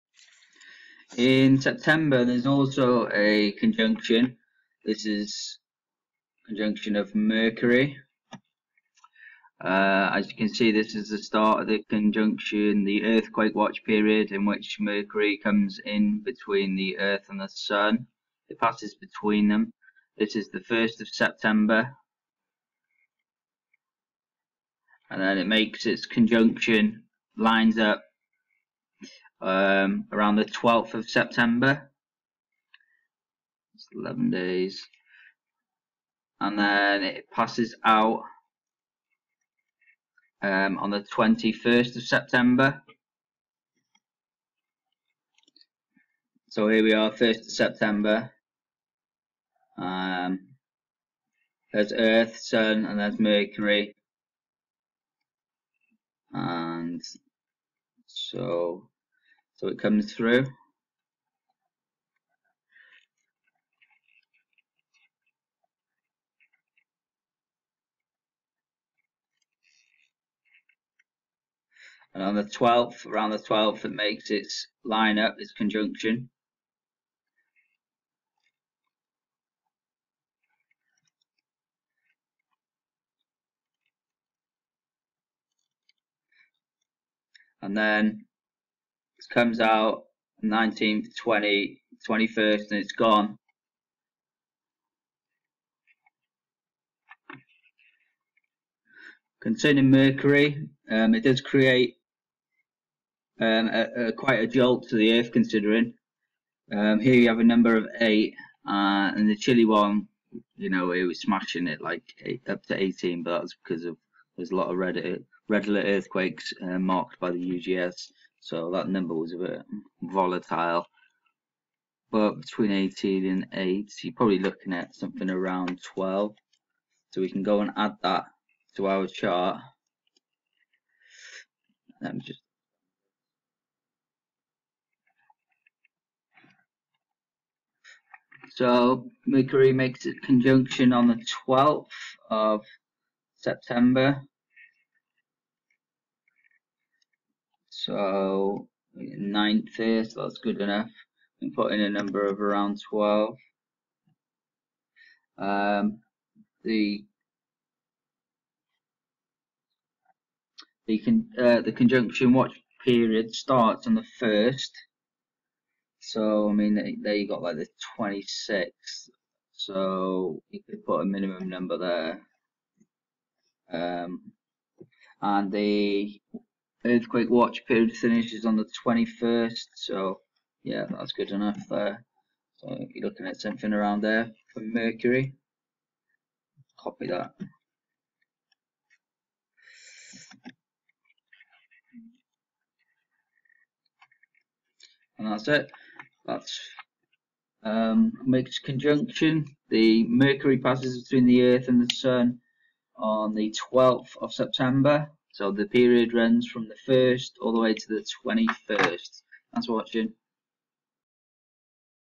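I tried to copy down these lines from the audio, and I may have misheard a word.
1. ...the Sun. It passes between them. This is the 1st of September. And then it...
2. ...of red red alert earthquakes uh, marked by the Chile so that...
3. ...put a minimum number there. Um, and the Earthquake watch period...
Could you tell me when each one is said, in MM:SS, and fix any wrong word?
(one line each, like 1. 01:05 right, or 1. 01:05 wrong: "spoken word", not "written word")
1. 00:17 right
2. 01:54 wrong: "UGS", not "Chile"
3. 02:50 right.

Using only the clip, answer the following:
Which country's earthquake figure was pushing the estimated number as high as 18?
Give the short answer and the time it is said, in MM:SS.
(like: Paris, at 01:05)
Chile, at 01:49.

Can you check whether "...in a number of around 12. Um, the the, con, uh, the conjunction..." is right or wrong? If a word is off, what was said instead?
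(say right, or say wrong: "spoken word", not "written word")
right.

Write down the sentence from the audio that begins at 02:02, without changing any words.
But between 18 and 8, you're probably looking at something around 12.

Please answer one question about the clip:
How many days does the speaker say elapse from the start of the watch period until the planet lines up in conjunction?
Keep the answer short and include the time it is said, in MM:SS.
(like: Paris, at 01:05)
11, at 00:33.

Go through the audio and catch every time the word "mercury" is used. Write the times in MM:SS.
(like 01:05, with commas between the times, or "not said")
00:07, 00:14, 00:53, 01:39, 02:19, 03:04, 03:20.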